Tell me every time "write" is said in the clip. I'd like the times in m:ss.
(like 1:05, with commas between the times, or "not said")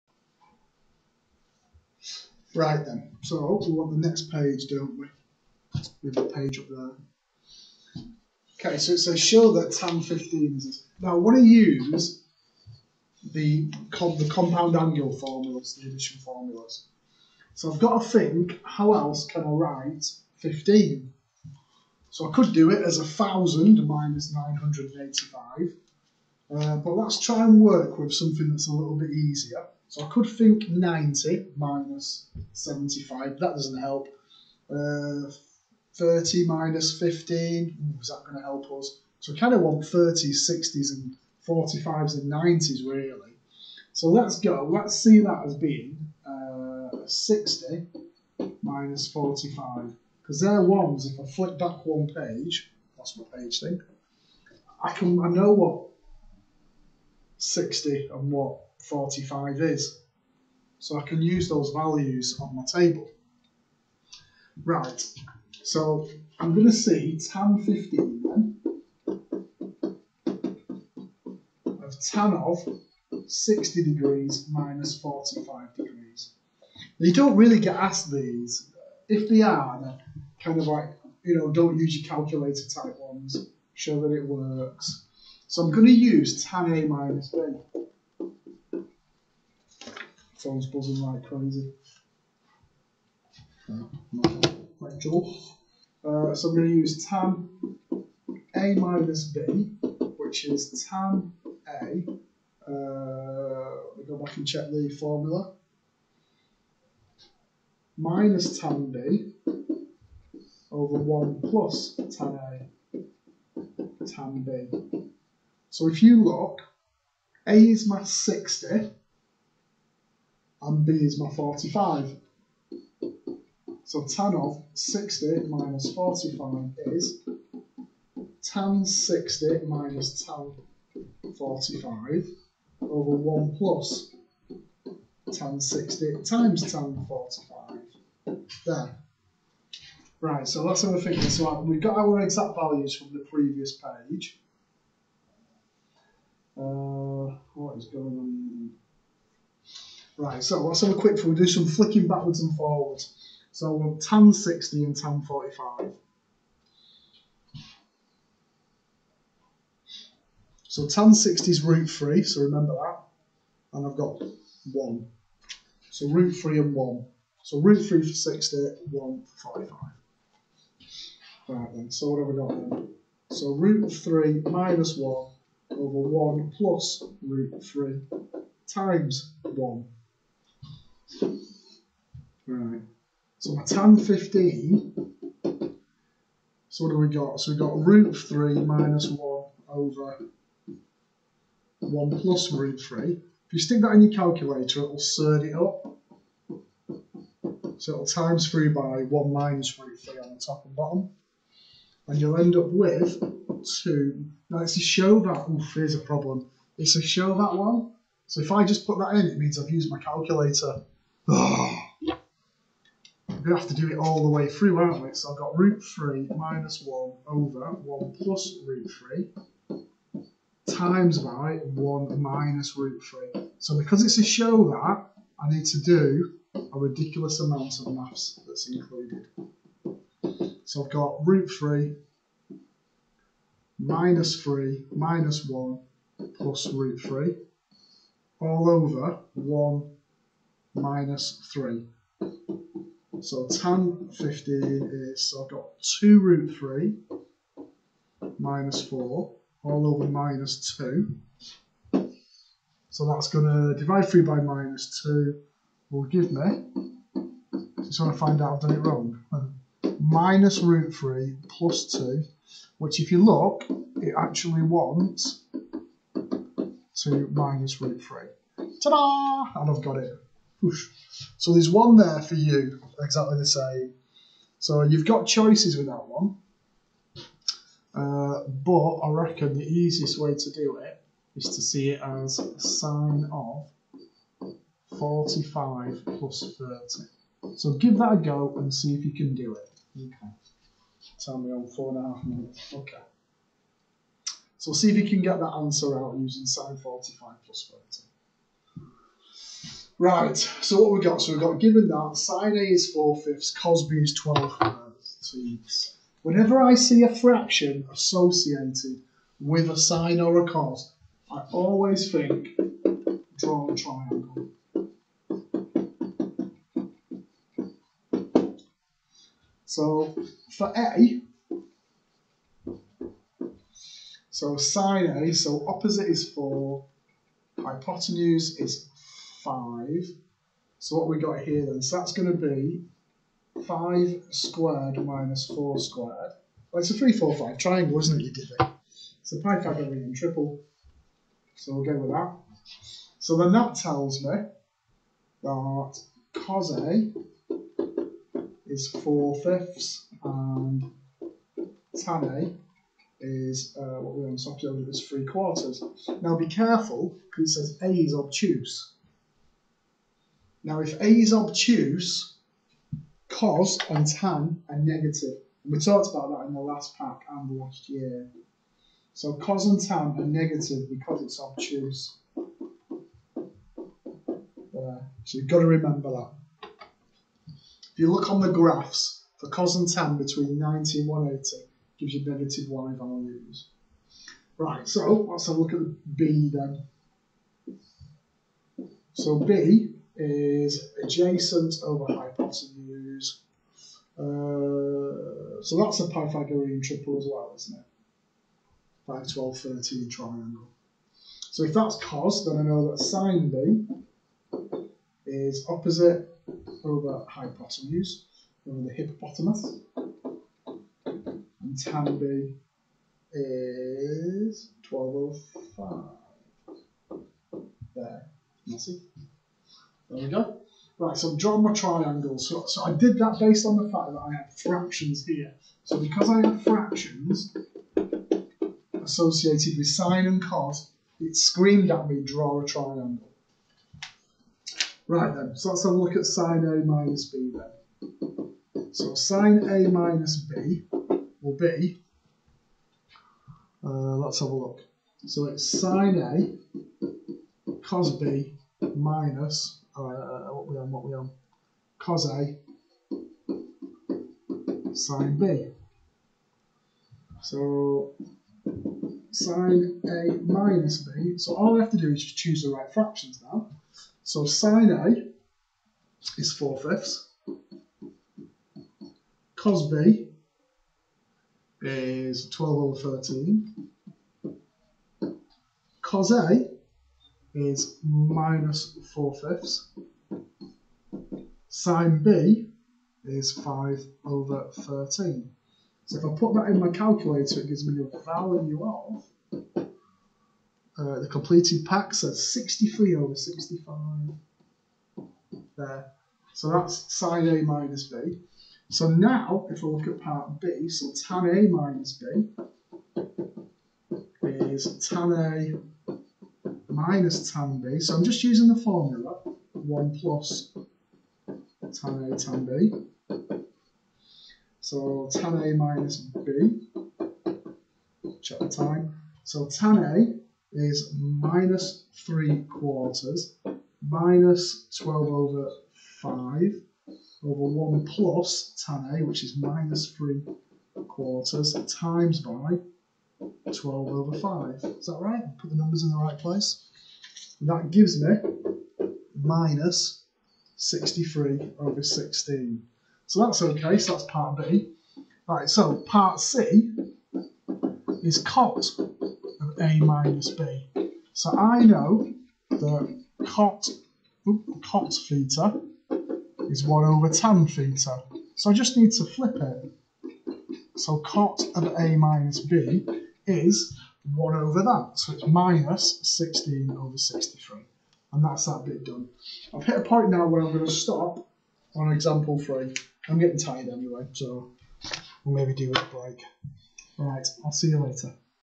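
0:19.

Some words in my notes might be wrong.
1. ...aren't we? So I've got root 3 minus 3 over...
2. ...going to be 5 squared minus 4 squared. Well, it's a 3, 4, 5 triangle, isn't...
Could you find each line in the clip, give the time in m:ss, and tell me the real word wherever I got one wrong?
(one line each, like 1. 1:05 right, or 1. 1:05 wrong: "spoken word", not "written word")
1. 3:34 wrong: "1", not "3"
2. 5:32 right.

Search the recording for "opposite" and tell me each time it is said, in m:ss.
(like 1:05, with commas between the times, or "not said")
5:25, 6:45.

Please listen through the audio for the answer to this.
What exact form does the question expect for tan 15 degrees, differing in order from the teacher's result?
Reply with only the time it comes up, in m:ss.
4:26.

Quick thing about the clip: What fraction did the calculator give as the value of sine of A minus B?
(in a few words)
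63/65.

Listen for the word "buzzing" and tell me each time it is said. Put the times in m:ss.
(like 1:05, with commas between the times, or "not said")
1:30.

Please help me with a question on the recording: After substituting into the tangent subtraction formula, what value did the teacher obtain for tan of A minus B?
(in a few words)
-63/16.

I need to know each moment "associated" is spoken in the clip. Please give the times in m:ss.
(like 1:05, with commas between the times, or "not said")
5:07, 7:09.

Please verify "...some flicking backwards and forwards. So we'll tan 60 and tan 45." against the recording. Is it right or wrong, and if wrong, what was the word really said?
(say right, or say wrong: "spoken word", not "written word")
right.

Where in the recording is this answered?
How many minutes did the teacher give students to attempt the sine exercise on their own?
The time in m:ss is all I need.
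4:51.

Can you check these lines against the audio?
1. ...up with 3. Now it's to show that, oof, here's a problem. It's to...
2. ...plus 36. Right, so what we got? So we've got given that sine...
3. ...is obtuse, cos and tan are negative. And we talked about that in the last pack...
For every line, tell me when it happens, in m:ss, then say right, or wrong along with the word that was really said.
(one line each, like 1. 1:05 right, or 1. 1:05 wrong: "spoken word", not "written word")
1. 3:22 wrong: "2", not "3"
2. 4:57 wrong: "30", not "36"
3. 6:01 right.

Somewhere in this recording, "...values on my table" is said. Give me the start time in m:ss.
1:01.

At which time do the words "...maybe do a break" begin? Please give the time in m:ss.
9:35.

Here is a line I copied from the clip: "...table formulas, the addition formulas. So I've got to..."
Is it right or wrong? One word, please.
wrong.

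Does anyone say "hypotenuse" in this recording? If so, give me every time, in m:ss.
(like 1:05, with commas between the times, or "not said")
5:27, 6:32, 6:47.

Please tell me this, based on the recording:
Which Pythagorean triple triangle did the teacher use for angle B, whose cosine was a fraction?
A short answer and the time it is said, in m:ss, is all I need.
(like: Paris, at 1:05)
5, 12, 13, at 6:39.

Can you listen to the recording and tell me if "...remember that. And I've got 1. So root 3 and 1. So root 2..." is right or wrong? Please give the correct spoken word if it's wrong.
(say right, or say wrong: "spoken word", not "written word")
wrong: "3", not "2".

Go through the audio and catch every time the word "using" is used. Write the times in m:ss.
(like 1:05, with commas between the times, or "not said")
4:56, 8:28.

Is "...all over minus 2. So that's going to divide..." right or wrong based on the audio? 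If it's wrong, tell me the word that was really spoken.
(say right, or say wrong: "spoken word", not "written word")
right.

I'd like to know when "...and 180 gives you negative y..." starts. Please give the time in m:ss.
6:20.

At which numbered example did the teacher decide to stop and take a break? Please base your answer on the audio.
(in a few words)
Example 3.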